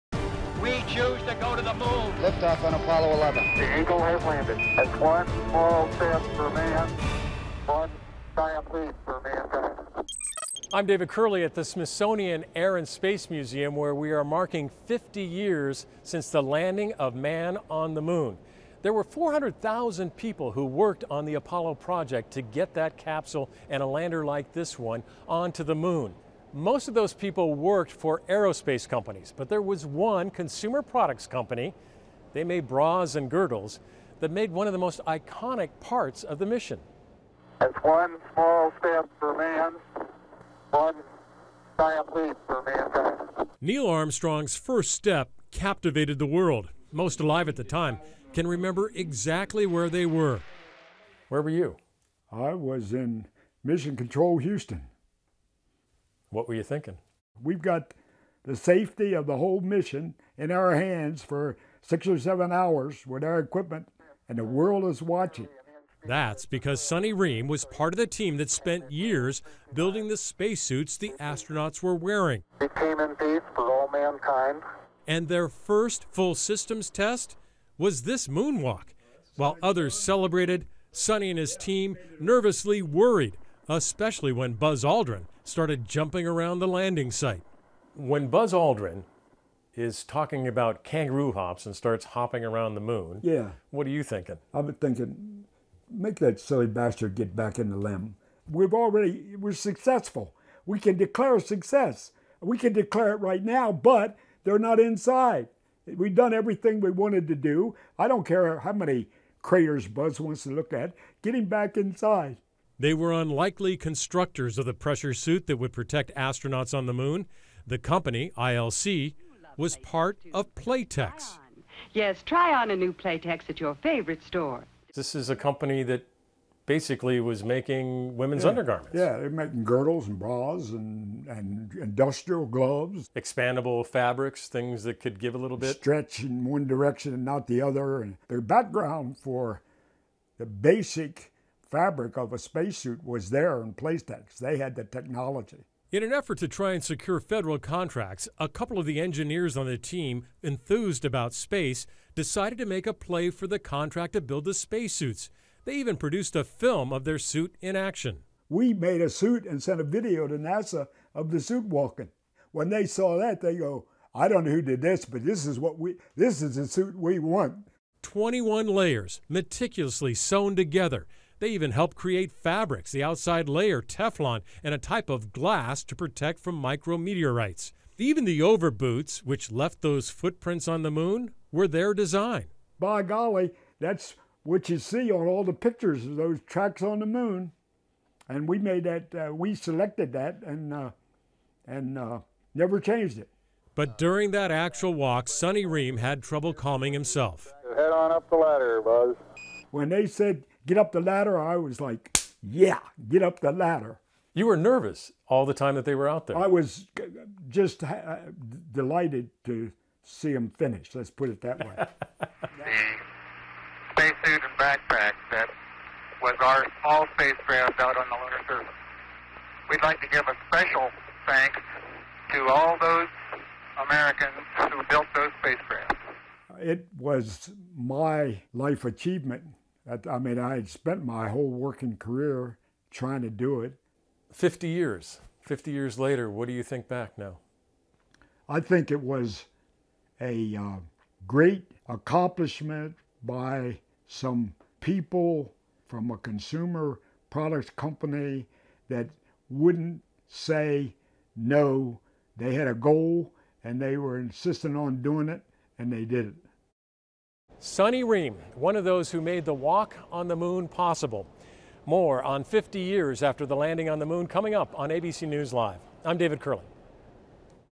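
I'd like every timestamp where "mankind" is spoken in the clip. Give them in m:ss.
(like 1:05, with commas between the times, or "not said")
0:09, 0:42, 1:13.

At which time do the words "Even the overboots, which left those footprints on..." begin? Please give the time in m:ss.
2:57.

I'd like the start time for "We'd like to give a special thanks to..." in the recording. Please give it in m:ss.
3:39.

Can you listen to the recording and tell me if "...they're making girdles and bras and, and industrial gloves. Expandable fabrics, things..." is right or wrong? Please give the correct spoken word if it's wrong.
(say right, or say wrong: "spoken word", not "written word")
right.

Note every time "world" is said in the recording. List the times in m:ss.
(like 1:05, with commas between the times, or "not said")
0:46, 1:04.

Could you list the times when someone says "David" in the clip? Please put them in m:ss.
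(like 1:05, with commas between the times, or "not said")
0:10, 4:26.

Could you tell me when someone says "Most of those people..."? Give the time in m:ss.
0:26.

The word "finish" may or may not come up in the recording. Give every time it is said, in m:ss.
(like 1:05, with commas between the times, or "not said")
3:30.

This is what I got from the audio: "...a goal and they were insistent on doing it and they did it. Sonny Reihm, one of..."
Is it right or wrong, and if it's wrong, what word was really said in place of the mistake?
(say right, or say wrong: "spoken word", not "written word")
right.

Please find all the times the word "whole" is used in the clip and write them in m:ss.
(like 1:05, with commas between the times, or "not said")
0:59, 3:51.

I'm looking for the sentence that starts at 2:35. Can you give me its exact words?
They even produced a film of their suit in action.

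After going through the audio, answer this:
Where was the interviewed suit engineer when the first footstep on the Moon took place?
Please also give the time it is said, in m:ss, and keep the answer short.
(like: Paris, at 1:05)
Mission Control Houston, at 0:53.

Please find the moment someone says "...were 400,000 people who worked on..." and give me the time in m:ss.
0:18.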